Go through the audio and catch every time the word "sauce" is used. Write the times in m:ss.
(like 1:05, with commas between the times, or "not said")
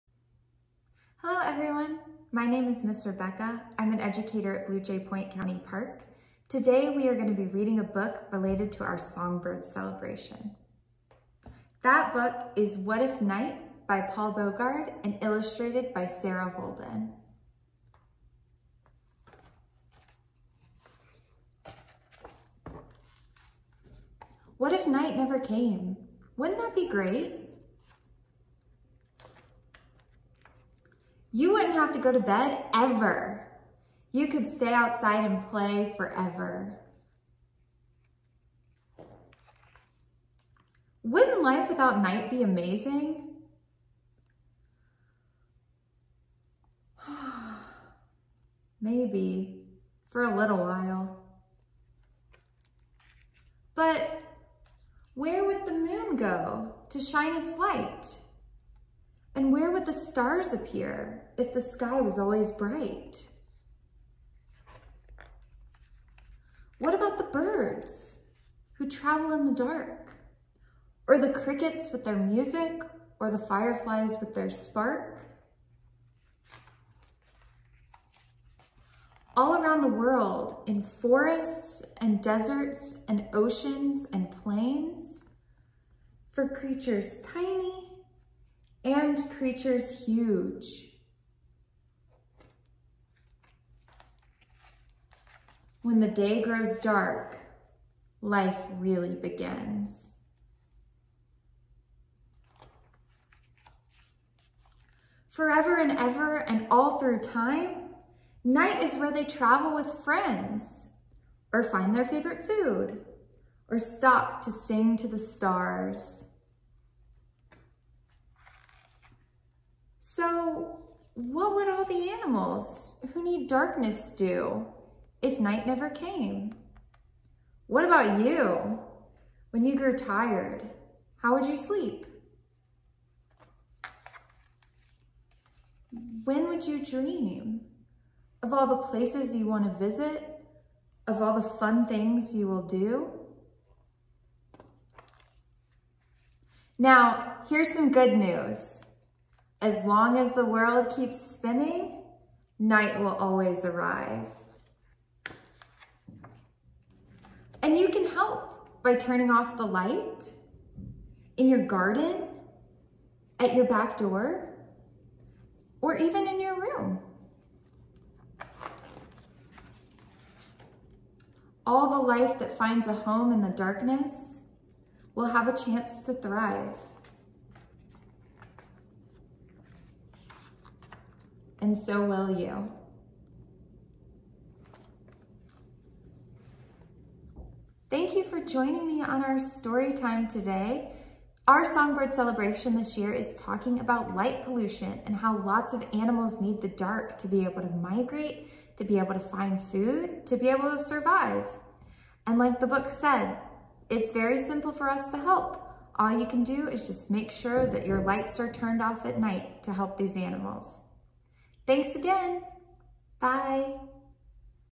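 not said.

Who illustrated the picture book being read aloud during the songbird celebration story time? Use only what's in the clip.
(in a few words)
Sarah Holden.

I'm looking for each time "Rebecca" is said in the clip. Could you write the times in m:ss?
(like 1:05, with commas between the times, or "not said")
0:03.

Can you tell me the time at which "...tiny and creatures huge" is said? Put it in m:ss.
1:27.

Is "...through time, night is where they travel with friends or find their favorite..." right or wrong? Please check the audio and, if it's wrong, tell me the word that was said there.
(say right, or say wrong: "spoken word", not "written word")
right.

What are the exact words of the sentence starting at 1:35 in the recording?
When the day grows dark, life really begins.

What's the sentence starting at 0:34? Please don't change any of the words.
You could stay outside and play forever.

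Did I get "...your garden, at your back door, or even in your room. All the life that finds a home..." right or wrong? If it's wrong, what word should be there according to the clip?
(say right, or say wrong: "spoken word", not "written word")
right.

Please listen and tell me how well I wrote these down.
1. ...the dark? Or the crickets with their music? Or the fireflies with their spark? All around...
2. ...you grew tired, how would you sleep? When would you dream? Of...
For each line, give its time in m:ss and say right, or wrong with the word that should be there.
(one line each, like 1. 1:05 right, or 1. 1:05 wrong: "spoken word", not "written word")
1. 1:09 right
2. 2:09 right.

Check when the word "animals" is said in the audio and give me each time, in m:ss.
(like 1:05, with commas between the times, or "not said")
2:02, 3:15, 3:30.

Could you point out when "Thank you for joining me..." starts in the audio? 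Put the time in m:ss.
3:07.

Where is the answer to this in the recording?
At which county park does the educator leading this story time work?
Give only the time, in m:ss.
0:04.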